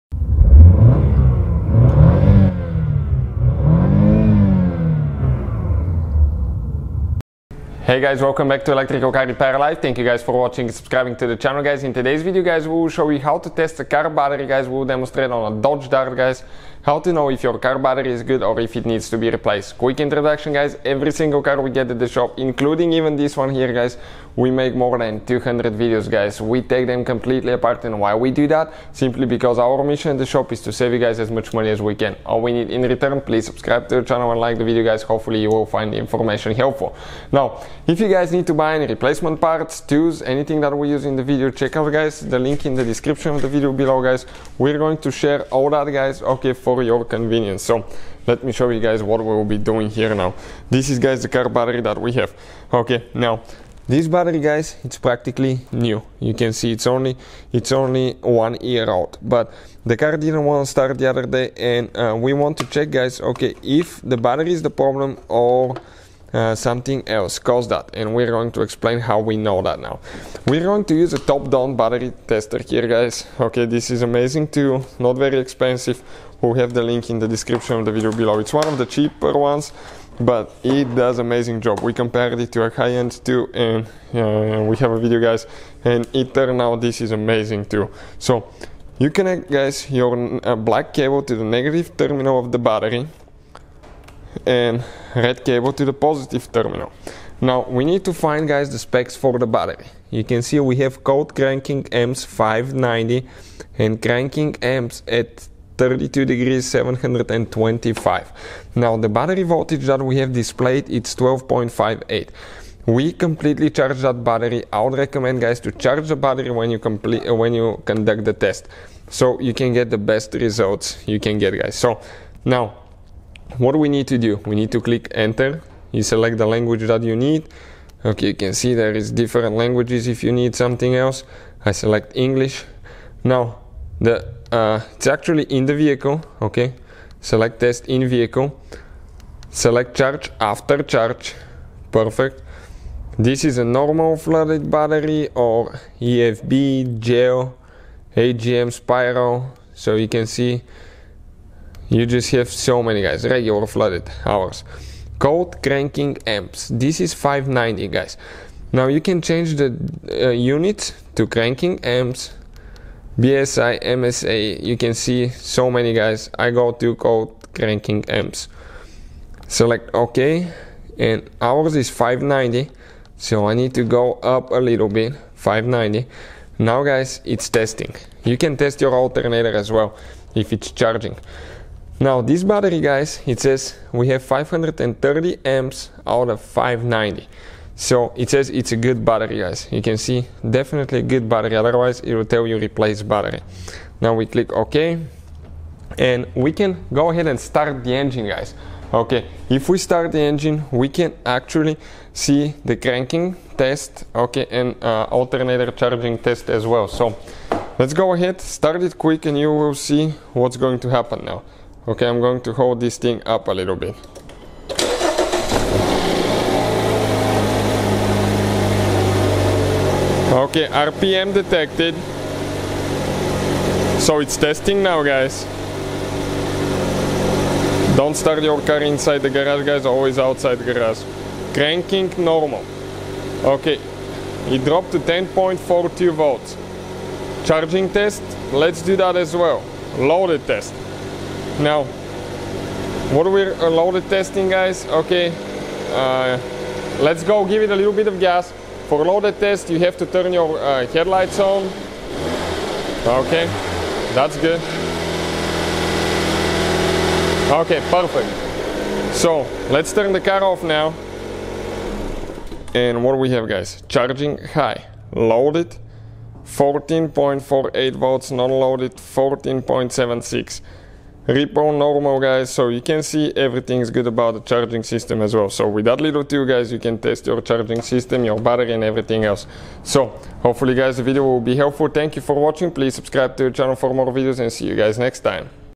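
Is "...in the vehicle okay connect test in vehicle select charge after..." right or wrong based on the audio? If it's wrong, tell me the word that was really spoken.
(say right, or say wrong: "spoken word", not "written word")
wrong: "select", not "connect".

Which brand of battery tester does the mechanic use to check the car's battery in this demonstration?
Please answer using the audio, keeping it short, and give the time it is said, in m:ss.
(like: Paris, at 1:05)
Topdon, at 1:11.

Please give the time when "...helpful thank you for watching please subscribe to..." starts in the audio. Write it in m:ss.
4:41.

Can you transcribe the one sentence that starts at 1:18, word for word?
It's one of the cheaper ones, but it does amazing job.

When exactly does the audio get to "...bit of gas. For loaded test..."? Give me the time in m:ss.
4:07.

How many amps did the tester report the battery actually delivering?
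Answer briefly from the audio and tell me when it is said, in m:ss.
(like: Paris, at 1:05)
530, at 3:04.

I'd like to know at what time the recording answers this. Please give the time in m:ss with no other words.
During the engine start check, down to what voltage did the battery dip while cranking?
3:54.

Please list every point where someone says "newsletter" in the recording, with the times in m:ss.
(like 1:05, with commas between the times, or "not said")
not said.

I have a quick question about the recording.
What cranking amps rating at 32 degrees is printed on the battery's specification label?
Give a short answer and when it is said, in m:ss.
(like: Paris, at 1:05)
725, at 1:46.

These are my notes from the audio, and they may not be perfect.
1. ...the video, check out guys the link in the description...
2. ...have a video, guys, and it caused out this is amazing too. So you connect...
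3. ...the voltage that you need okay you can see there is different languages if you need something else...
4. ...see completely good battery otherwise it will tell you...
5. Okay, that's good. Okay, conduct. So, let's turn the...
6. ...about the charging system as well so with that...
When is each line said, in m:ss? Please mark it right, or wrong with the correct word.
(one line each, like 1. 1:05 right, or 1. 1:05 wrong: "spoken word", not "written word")
1. 0:41 right
2. 1:24 wrong: "turned", not "caused"
3. 2:06 wrong: "language", not "voltage"
4. 3:09 wrong: "definitely", not "completely"
5. 4:13 wrong: "perfect", not "conduct"
6. 4:34 right.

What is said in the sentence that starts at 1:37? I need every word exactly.
Now we need to find guys the specs for the battery.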